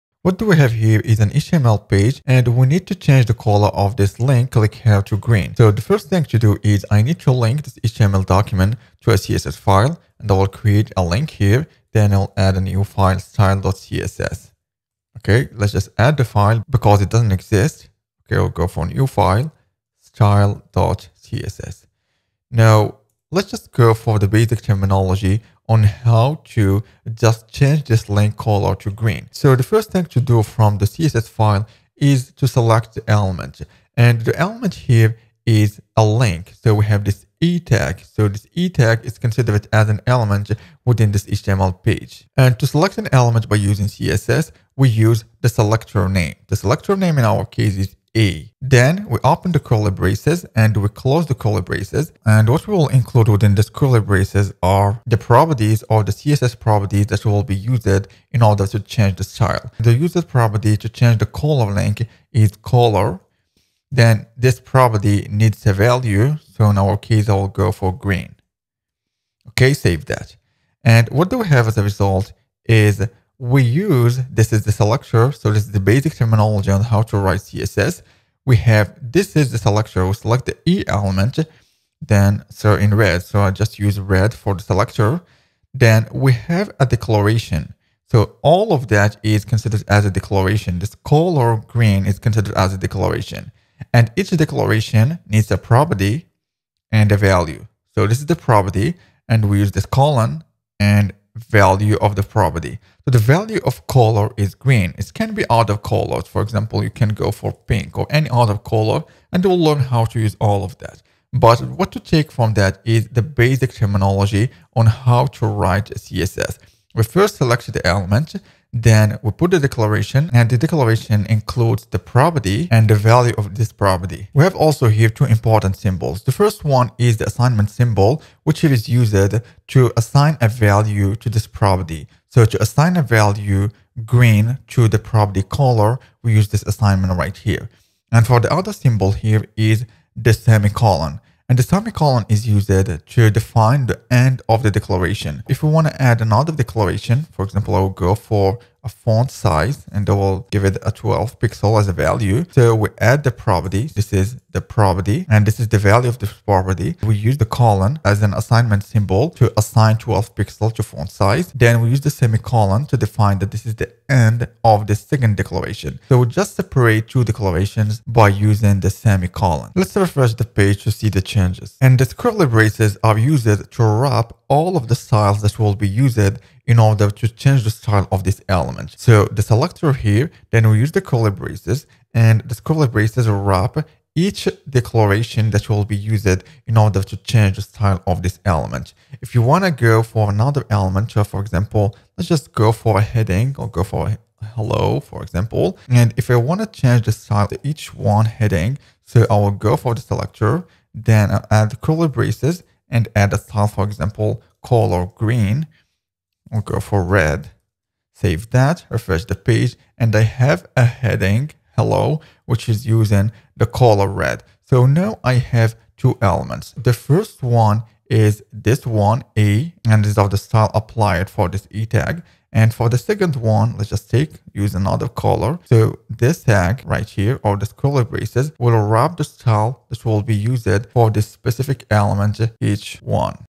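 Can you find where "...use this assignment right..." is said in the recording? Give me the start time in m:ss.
2:16.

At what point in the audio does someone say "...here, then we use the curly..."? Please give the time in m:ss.
2:59.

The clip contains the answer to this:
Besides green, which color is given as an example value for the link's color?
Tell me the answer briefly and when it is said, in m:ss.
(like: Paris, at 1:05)
pink, at 1:47.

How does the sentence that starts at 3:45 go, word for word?
So this tag right here, or this scroller braces, will wrap the style that will be used for this specific element, h1.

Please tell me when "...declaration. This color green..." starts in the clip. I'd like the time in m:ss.
1:30.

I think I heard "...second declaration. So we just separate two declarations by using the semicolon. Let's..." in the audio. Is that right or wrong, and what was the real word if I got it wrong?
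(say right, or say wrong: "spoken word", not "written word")
right.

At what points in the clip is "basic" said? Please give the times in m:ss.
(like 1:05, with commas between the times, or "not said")
0:24, 1:15, 1:53.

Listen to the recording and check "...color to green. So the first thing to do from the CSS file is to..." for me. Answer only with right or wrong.
right.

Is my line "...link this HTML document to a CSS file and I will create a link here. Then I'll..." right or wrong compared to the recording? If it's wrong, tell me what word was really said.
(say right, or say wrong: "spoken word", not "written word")
right.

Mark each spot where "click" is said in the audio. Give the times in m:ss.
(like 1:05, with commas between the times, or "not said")
0:04.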